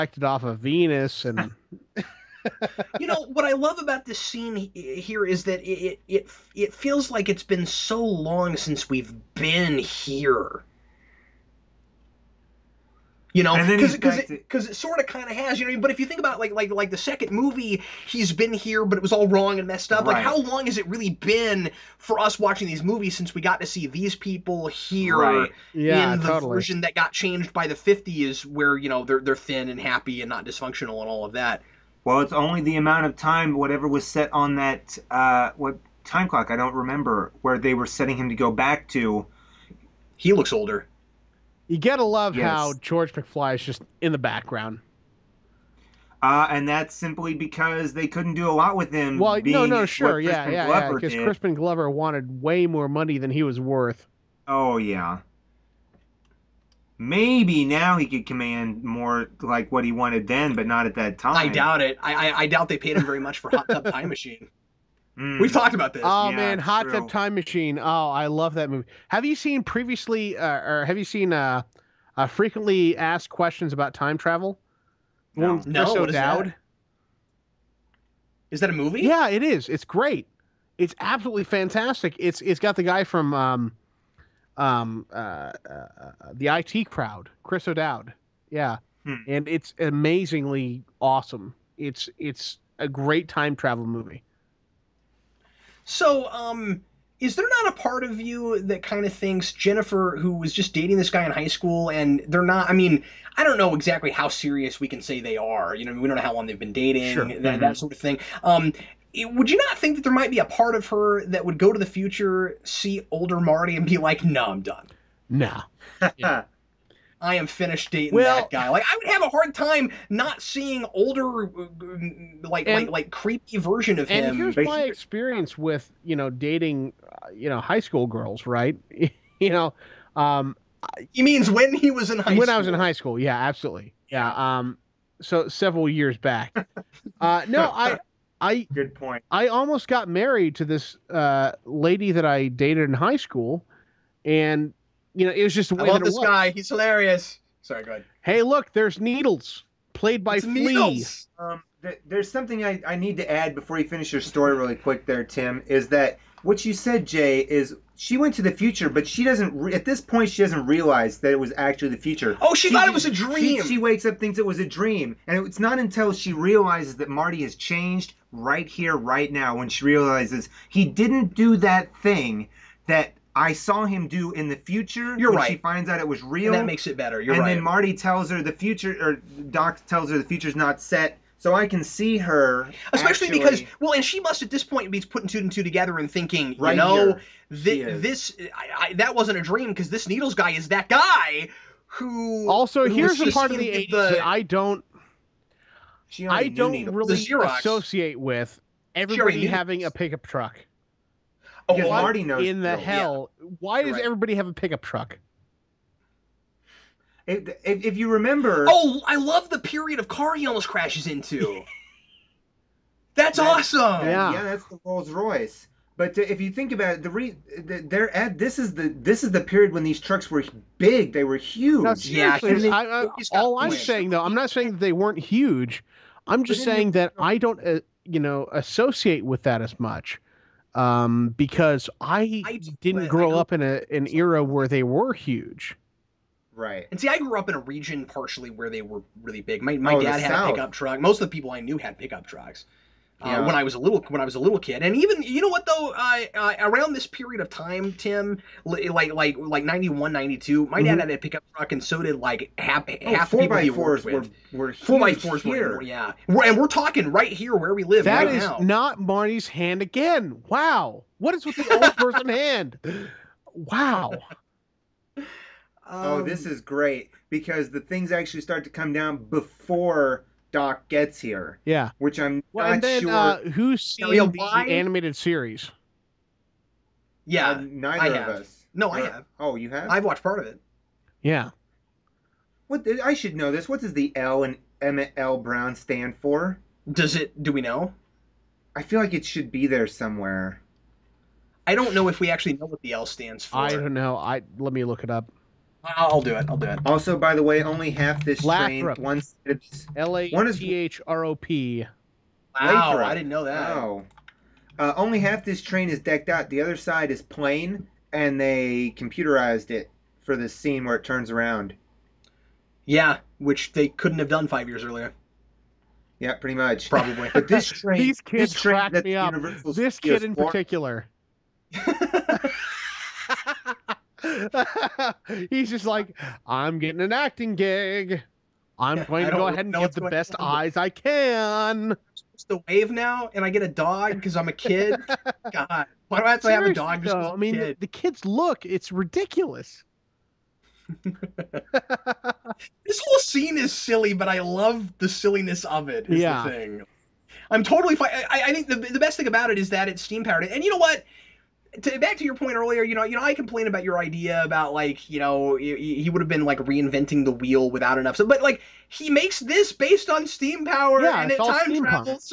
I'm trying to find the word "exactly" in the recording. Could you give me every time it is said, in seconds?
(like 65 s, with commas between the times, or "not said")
103 s.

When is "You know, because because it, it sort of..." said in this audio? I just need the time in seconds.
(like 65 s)
13 s.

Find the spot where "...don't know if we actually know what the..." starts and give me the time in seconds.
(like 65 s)
291 s.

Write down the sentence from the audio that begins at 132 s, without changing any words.
I was in high school, yeah, absolutely, yeah.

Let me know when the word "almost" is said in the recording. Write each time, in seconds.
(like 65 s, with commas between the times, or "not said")
139 s, 210 s.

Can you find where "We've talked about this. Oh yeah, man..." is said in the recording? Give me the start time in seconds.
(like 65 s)
65 s.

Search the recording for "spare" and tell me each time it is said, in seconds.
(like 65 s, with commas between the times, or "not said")
not said.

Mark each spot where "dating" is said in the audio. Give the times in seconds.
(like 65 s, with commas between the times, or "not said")
100 s, 106 s, 117 s, 126 s.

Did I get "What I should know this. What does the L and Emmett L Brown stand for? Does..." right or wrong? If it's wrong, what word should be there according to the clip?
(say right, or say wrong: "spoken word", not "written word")
right.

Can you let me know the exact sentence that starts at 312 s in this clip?
Yeah, which they couldn't have done five years earlier.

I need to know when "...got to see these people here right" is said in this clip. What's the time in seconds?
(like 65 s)
23 s.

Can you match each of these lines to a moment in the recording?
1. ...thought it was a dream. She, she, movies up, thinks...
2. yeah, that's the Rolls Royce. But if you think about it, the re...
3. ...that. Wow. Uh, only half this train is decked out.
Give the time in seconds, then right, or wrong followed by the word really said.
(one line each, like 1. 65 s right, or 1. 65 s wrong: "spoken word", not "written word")
1. 162 s wrong: "wakes", not "movies"
2. 214 s right
3. 303 s right.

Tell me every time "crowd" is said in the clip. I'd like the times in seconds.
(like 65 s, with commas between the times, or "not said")
86 s.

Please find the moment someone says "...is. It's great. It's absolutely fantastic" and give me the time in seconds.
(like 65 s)
79 s.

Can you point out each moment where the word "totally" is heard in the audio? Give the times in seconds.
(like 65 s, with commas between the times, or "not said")
26 s, 347 s.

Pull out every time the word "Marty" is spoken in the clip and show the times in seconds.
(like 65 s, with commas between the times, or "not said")
113 s, 167 s, 177 s, 201 s, 259 s.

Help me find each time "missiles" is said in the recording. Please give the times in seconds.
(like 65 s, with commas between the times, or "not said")
not said.